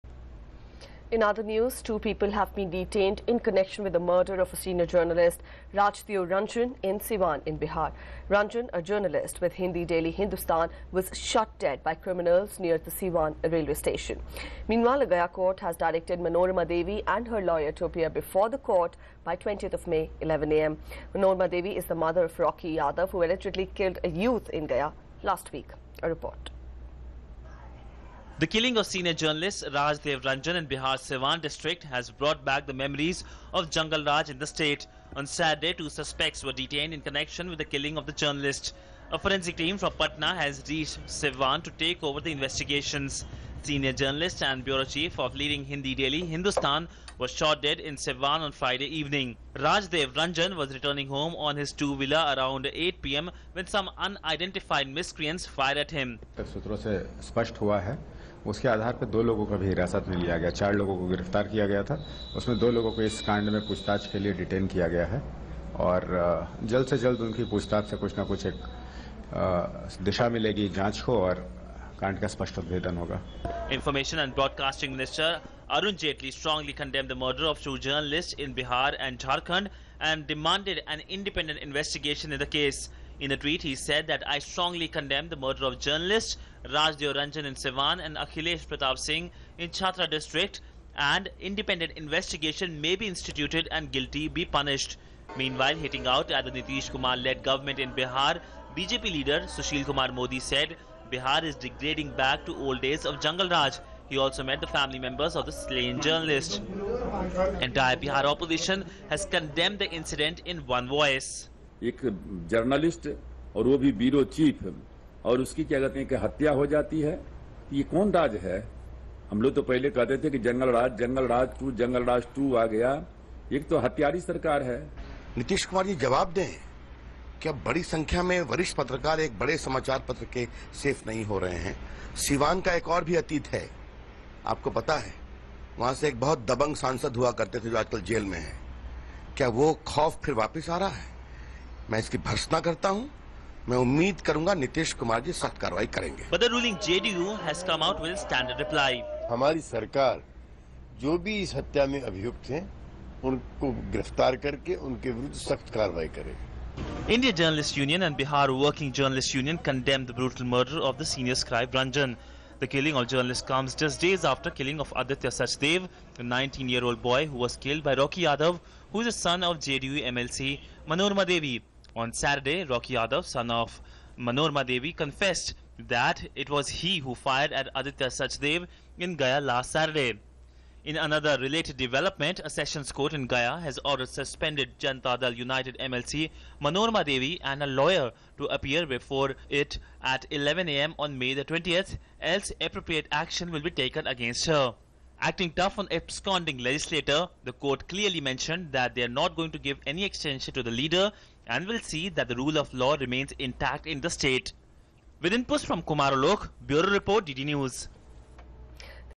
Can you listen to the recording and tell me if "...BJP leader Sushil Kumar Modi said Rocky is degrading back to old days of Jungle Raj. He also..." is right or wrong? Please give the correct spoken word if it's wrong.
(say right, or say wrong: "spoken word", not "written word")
wrong: "Bihar", not "Rocky".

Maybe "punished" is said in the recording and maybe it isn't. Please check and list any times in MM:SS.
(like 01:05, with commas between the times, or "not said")
01:34.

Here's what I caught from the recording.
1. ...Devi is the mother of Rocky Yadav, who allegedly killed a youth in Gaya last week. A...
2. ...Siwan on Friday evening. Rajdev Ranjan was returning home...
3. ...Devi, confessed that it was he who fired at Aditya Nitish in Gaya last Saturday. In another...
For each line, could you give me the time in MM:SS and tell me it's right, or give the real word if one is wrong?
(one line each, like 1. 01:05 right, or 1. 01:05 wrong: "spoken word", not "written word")
1. 00:21 right
2. 00:47 right
3. 02:54 wrong: "Sachdev", not "Nitish".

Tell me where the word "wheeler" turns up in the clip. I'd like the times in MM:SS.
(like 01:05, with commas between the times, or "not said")
00:51.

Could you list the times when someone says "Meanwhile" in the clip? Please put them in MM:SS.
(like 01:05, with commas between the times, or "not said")
00:14, 01:35.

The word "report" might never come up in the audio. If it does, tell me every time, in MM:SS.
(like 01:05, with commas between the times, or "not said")
00:26, 03:26.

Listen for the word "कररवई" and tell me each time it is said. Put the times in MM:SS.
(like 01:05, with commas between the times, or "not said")
02:25, 02:35.